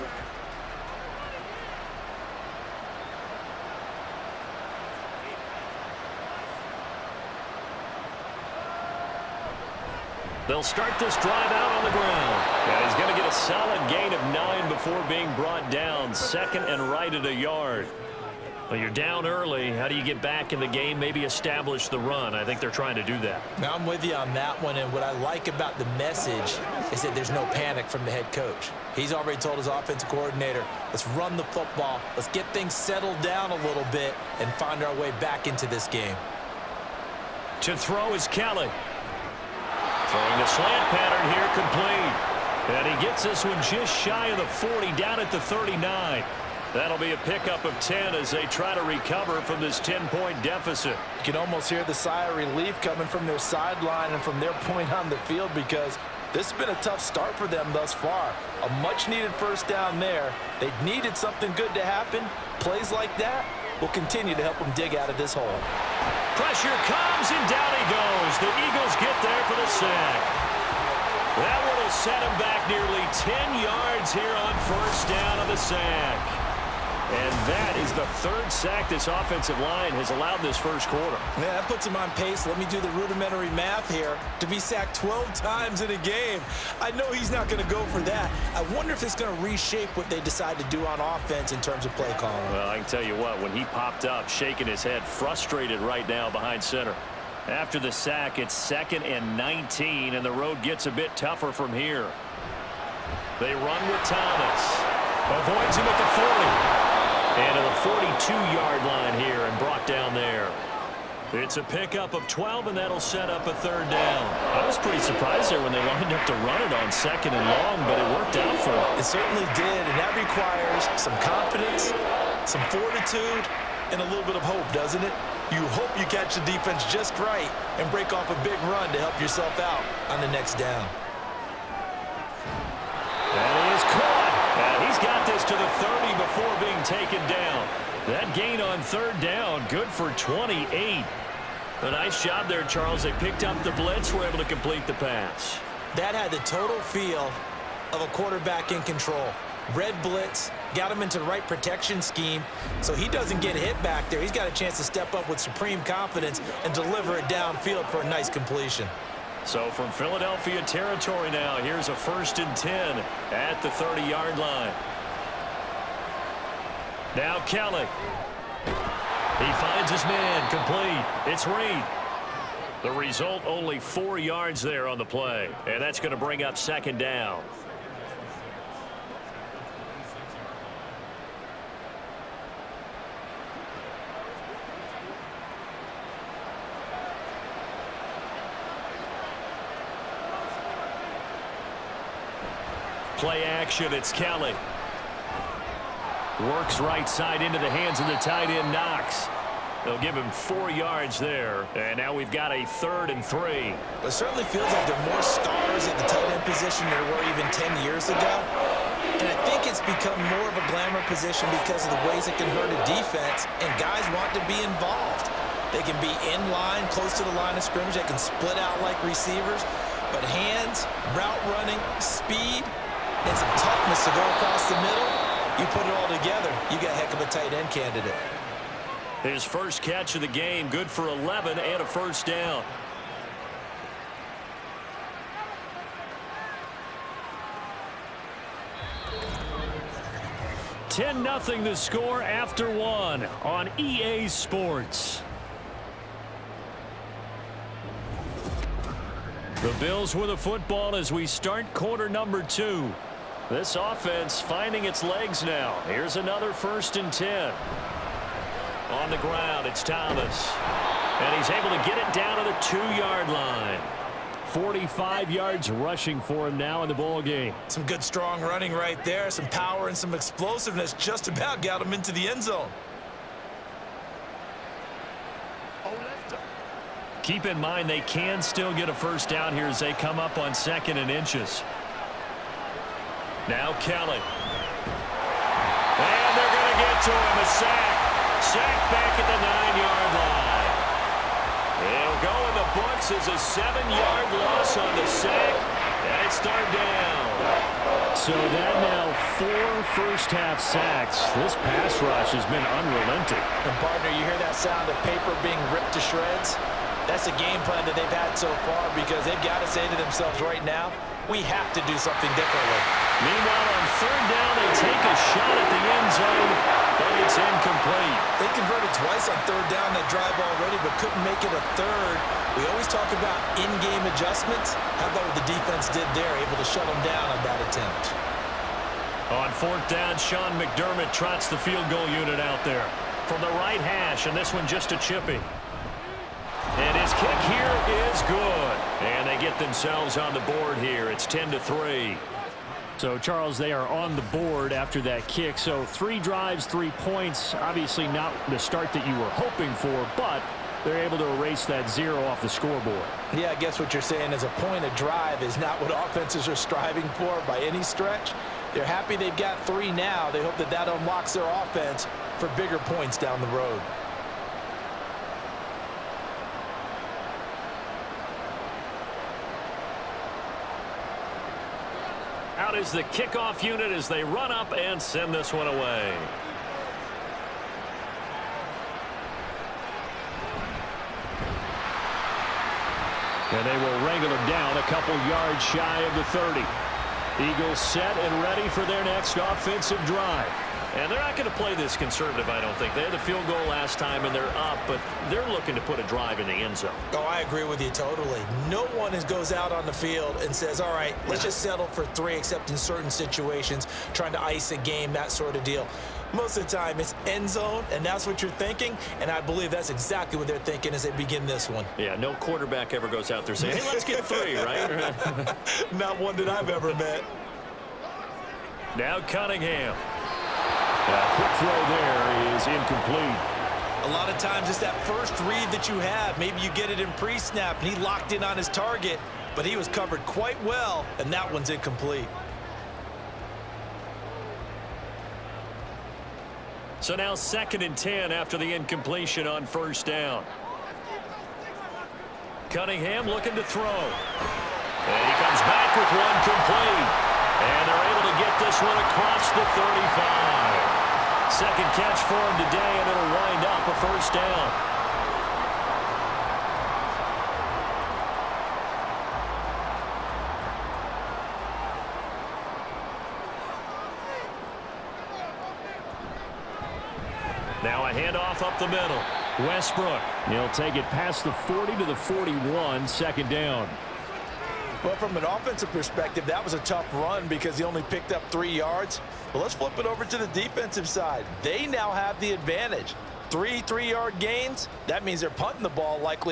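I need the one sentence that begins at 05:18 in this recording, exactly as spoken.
They converted twice on third down that drive already, but couldn't make it a third.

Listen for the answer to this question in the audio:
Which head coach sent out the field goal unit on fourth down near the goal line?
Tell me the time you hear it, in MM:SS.
05:30.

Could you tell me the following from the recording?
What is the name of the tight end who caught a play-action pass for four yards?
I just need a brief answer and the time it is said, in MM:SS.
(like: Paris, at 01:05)
Knox, at 03:18.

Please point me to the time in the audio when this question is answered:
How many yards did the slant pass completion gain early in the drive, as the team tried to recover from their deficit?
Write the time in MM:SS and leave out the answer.
00:47.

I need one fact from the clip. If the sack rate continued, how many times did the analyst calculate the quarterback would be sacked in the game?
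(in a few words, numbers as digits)
12.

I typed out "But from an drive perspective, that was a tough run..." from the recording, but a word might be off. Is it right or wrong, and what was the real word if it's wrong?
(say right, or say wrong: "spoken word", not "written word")
wrong: "offensive", not "drive".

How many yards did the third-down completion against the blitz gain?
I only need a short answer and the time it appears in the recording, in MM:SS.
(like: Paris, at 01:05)
28, at 02:19.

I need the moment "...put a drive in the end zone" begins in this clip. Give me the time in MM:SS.
06:35.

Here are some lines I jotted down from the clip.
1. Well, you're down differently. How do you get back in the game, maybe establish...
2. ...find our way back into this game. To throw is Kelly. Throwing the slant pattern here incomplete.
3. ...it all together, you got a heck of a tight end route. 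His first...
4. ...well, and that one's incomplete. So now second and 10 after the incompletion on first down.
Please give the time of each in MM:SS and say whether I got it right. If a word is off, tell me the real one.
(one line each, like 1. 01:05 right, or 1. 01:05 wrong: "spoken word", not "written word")
1. 00:18 wrong: "early", not "differently"
2. 00:34 wrong: "complete", not "incomplete"
3. 03:45 wrong: "candidate", not "route"
4. 07:10 right.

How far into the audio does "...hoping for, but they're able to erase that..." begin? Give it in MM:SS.
05:49.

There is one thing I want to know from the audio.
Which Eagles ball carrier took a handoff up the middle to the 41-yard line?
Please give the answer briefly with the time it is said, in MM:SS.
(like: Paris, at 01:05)
Westbrook, at 07:49.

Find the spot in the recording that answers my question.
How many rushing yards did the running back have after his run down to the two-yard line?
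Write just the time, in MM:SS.
04:24.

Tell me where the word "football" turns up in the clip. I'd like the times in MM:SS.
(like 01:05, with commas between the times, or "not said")
00:31, 04:10.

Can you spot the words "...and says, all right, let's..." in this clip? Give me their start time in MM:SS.
06:40.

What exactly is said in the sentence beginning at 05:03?
And, partner, you hear that sound of paper being ripped to shreds?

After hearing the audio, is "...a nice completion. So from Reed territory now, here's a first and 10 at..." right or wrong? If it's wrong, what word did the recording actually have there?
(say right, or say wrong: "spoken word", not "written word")
wrong: "Philadelphia", not "Reed".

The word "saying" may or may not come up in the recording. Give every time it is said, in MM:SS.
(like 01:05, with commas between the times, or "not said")
05:54, 06:53.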